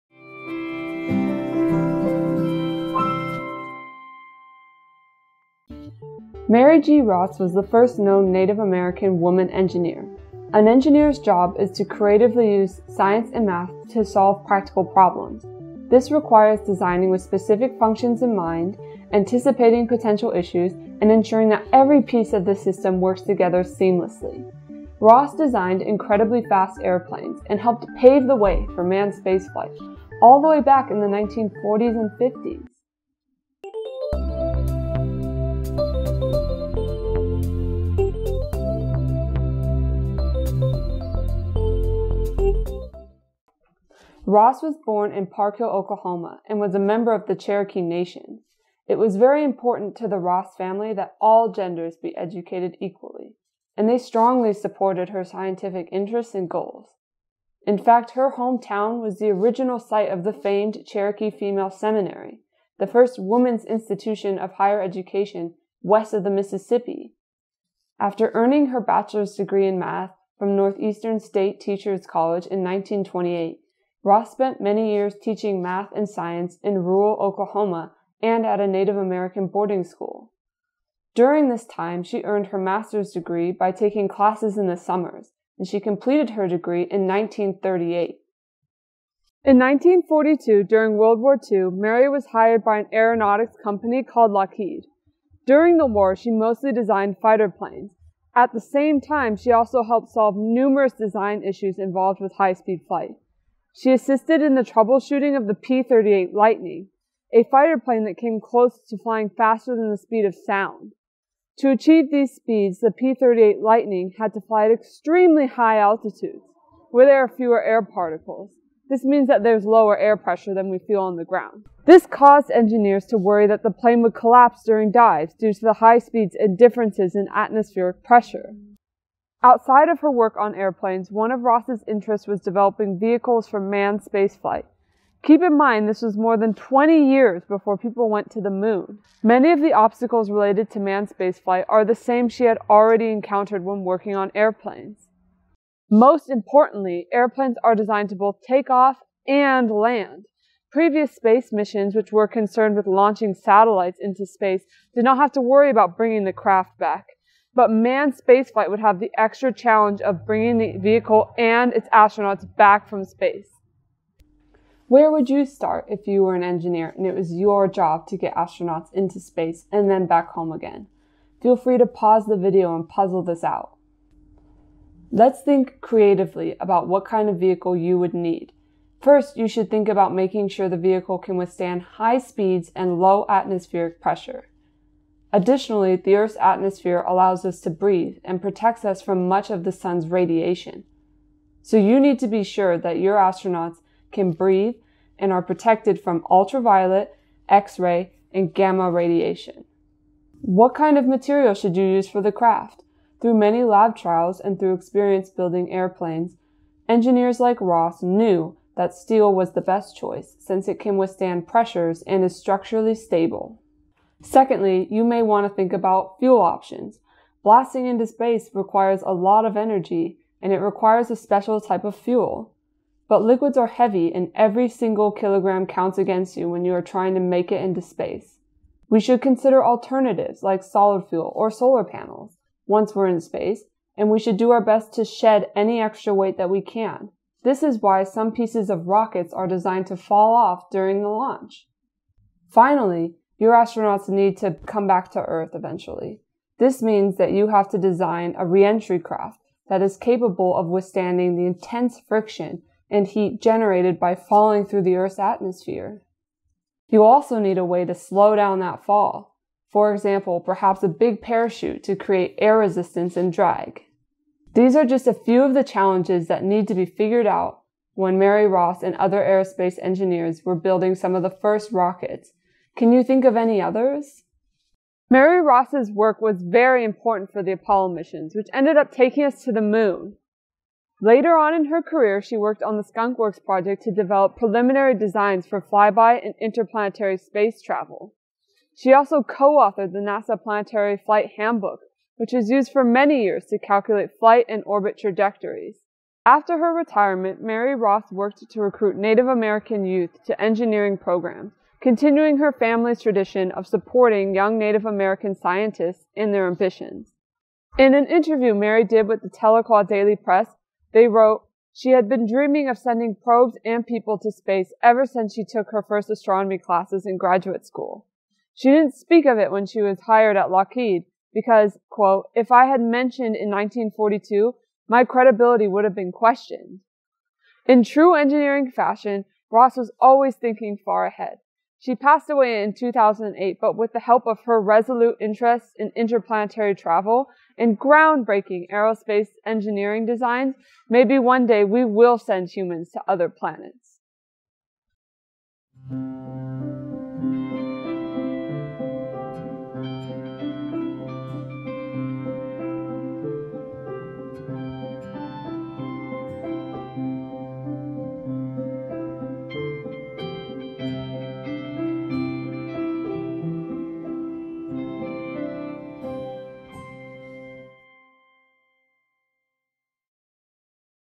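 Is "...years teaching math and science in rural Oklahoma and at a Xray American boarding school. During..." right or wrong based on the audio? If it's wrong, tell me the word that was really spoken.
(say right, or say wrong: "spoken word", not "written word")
wrong: "Native", not "Xray".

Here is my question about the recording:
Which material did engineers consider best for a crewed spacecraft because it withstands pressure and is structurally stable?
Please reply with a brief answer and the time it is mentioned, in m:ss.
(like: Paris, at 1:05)
Steel, at 3:28.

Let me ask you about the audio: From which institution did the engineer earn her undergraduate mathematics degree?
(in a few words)
Northeastern State Teachers College.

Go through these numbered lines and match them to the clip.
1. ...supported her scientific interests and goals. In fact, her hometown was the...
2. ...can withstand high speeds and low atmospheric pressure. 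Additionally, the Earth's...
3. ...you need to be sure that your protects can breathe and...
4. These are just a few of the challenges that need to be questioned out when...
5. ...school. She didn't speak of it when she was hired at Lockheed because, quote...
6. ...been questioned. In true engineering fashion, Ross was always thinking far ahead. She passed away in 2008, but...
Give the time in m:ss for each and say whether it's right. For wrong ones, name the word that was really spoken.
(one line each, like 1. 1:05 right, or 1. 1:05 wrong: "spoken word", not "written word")
1. 0:54 right
2. 3:01 right
3. 3:11 wrong: "astronauts", not "protects"
4. 4:24 wrong: "figured", not "questioned"
5. 5:17 right
6. 5:25 right.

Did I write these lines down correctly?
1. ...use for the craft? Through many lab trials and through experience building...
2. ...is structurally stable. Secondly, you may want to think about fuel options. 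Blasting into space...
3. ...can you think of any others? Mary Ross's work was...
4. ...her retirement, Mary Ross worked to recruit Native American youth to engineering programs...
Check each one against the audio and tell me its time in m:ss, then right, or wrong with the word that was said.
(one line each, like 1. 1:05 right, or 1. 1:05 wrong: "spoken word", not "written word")
1. 3:21 right
2. 3:32 right
3. 4:32 right
4. 4:56 right.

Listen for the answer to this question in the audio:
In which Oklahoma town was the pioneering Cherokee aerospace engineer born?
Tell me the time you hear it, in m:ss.
0:45.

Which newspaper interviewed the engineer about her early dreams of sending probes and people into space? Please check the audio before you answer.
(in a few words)
Tahlequah Daily Press.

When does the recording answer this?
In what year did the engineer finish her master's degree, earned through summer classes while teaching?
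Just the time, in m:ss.
1:27.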